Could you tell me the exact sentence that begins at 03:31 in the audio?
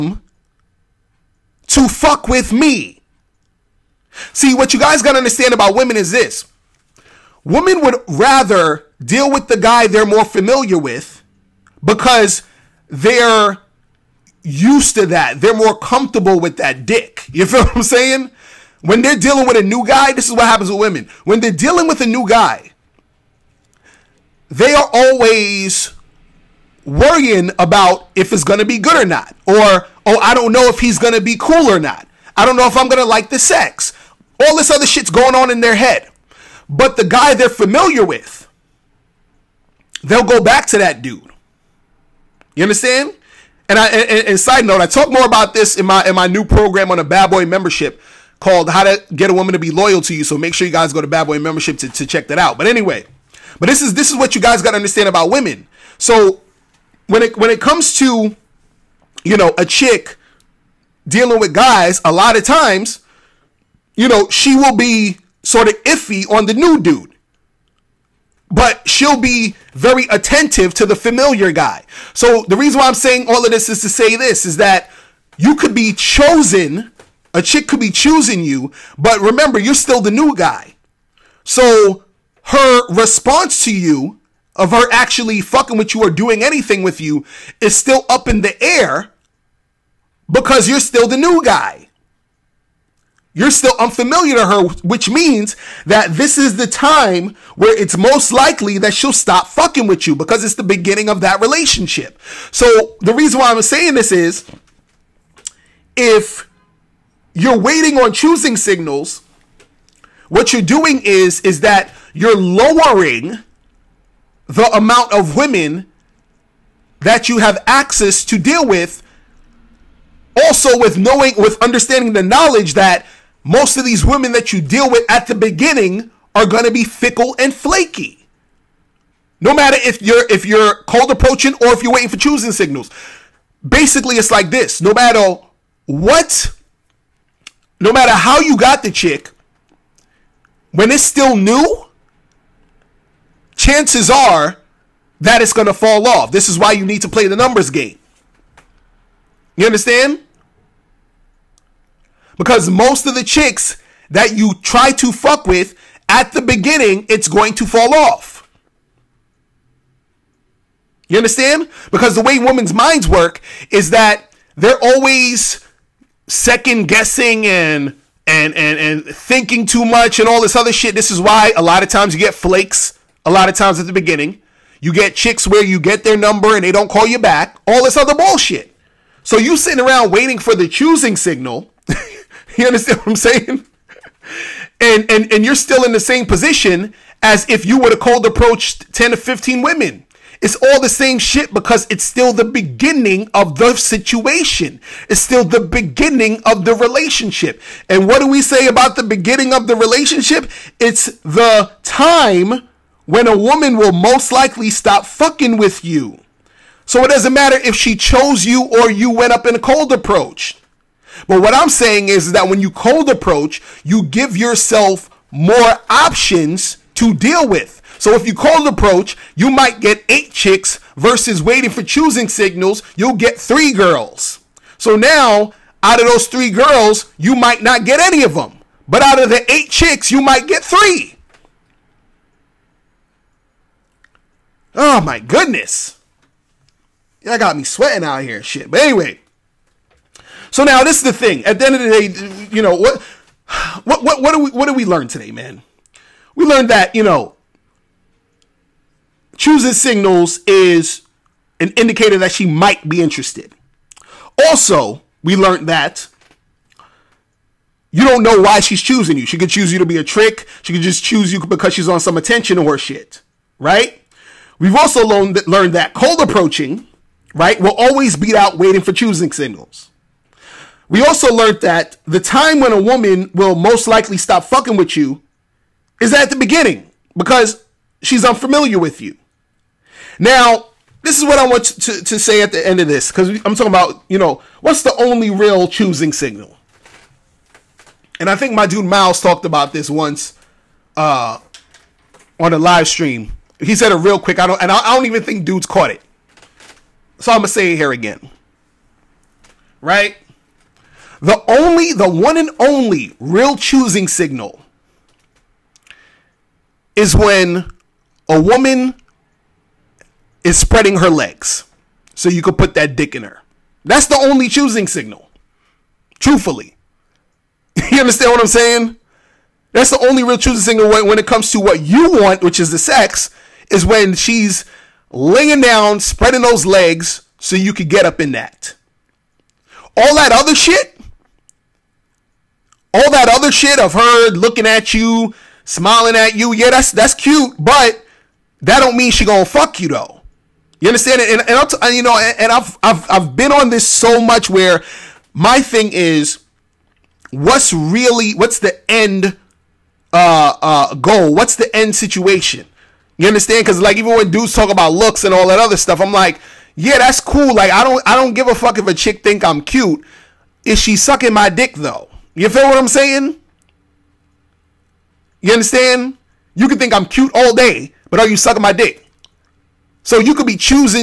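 But what I'm saying is that when you cold approach, you give yourself more options to deal with.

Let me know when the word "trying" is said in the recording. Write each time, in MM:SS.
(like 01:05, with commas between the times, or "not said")
not said.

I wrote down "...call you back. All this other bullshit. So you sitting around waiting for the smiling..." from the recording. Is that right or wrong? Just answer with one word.
wrong.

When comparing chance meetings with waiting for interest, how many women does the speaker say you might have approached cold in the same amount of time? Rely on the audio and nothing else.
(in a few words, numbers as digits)
10 to 15.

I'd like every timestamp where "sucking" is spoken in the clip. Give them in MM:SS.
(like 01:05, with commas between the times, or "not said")
06:00, 06:08.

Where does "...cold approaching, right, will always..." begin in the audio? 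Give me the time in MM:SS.
04:25.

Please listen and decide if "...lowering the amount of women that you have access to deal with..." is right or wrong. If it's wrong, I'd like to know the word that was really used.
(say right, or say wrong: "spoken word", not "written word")
right.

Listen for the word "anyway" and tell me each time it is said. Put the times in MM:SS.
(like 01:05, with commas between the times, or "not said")
00:52, 03:58.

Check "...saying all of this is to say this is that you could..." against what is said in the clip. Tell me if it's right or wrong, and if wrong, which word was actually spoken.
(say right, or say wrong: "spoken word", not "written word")
right.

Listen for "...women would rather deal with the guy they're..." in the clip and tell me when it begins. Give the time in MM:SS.
00:07.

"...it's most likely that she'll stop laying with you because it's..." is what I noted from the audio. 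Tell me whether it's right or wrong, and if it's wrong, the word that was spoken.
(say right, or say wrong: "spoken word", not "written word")
wrong: "fucking", not "laying".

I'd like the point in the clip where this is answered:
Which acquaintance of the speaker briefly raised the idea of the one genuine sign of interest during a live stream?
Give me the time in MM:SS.
04:48.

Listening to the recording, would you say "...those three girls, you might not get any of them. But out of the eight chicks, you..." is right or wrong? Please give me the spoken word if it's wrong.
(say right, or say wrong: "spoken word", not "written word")
right.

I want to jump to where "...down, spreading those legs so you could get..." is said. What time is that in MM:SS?
05:25.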